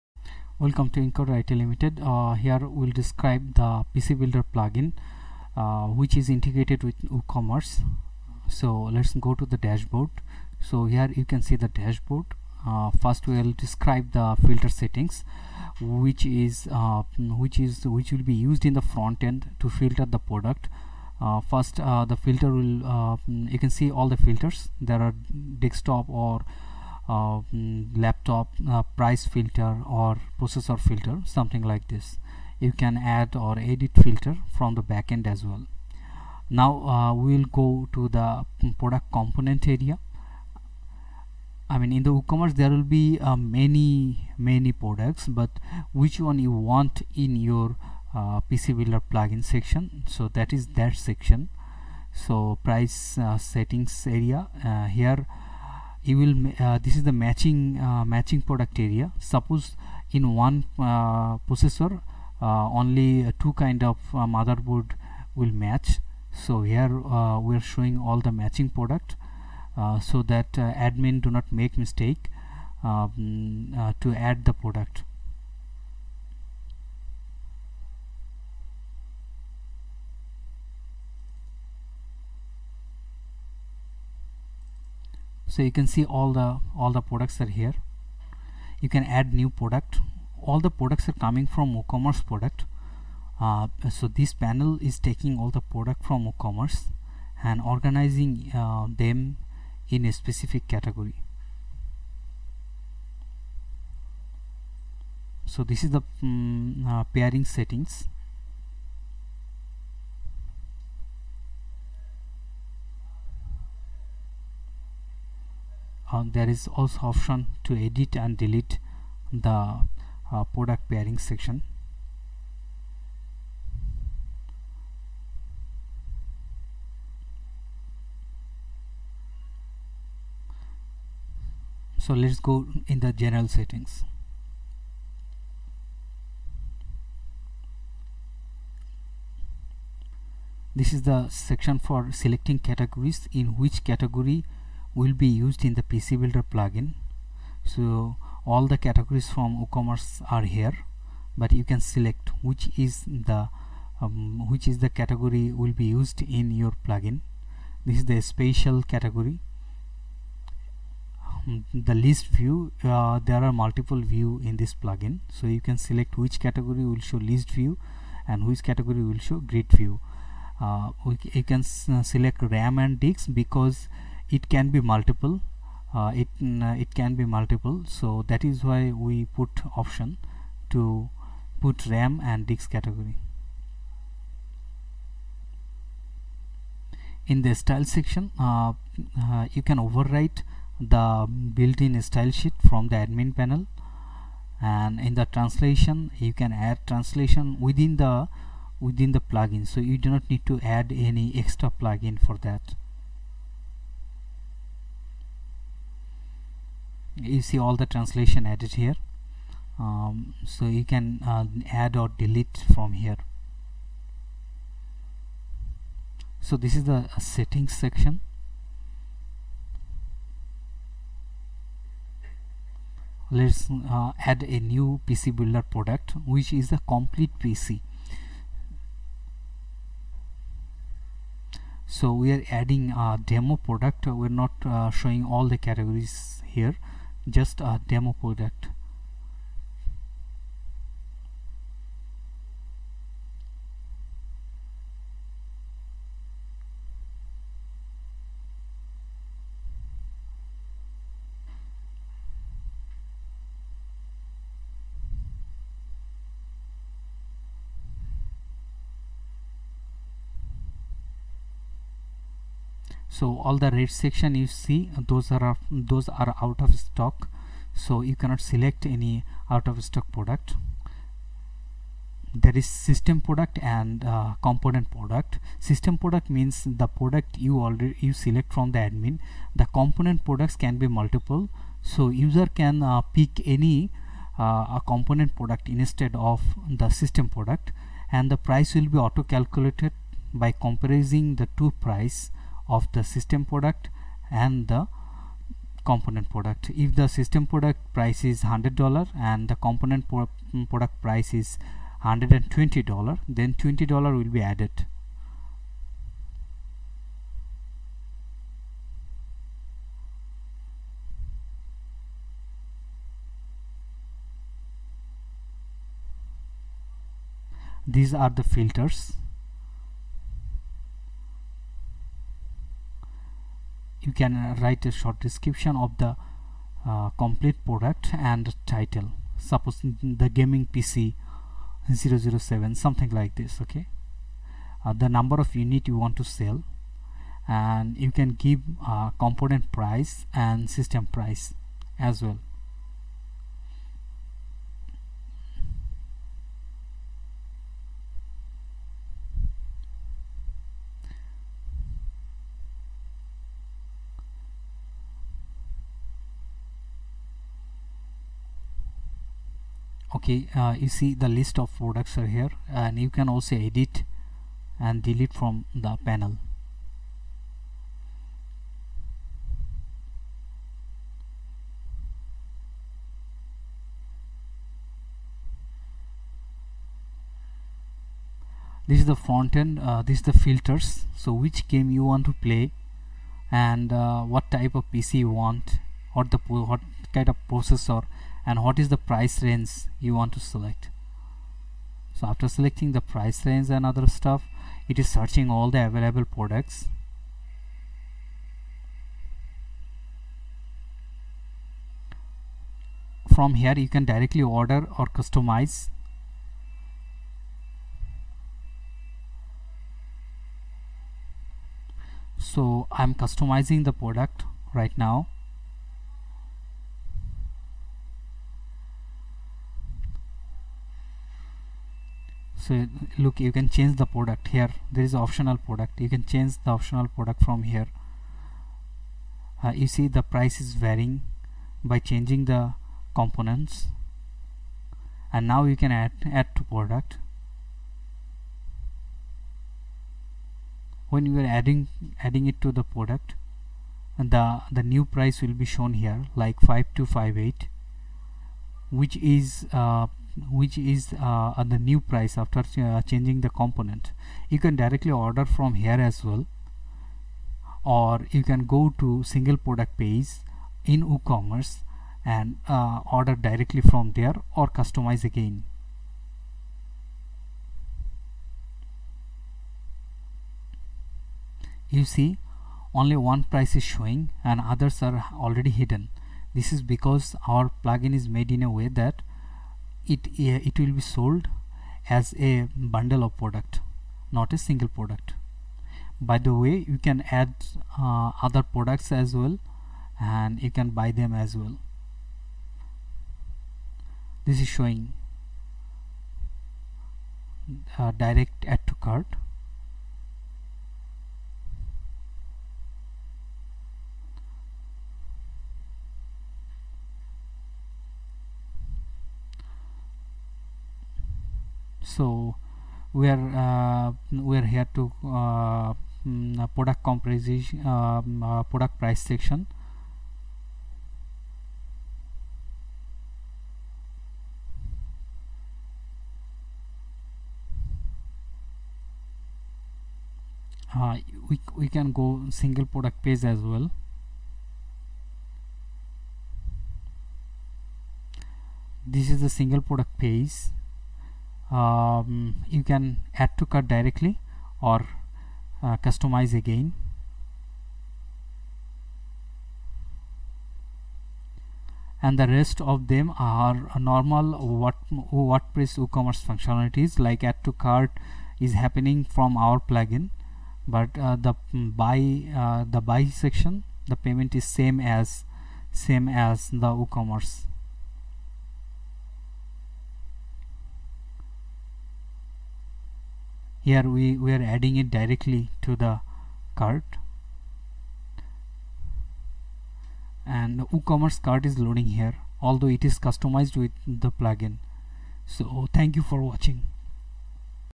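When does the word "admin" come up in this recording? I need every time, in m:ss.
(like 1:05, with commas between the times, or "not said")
1:10, 3:12, 4:38.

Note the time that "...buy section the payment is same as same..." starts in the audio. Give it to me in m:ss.
9:23.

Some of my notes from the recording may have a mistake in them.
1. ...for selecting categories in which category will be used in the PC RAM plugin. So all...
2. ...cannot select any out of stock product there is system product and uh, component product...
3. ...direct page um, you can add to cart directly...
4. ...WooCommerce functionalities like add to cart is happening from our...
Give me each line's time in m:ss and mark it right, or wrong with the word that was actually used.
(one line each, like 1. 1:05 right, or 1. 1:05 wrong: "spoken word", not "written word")
1. 2:21 wrong: "Builder", not "RAM"
2. 4:28 right
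3. 8:59 wrong: "product", not "direct"
4. 9:15 right.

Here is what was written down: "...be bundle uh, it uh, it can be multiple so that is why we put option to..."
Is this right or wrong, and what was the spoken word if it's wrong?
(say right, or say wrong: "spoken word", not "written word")
wrong: "multiple", not "bundle".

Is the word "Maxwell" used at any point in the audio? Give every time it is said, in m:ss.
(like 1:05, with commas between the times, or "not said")
not said.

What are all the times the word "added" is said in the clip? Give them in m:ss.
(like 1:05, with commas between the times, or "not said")
3:28, 5:04.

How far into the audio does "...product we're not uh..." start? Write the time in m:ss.
3:53.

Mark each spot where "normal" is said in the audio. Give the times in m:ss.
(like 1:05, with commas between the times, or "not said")
9:13.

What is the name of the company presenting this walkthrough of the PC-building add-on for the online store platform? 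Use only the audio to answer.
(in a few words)
Encoder IT Limited.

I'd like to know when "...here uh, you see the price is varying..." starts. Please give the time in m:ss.
7:07.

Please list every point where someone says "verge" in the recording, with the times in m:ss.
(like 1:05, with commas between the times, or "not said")
not said.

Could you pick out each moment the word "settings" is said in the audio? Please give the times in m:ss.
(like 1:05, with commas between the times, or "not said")
0:14, 0:53, 1:47, 2:13, 3:37.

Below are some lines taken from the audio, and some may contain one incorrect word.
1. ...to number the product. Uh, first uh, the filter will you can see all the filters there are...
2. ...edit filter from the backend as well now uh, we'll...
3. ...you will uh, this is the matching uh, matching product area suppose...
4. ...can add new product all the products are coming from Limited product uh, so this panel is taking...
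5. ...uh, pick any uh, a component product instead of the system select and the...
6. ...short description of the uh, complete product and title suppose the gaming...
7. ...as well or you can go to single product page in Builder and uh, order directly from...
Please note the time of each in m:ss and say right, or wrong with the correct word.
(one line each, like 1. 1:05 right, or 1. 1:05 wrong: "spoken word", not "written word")
1. 0:19 wrong: "filter", not "number"
2. 0:33 right
3. 0:56 right
4. 1:28 wrong: "WooCommerce", not "Limited"
5. 4:42 wrong: "product", not "select"
6. 5:24 right
7. 7:36 wrong: "WooCommerce", not "Builder".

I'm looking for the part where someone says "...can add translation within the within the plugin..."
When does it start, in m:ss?
3:16.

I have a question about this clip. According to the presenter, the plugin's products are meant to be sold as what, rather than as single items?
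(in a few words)
a bundle.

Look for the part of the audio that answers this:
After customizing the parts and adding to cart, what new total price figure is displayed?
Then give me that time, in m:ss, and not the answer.
7:26.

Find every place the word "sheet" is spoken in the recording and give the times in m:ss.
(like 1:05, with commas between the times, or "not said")
3:12.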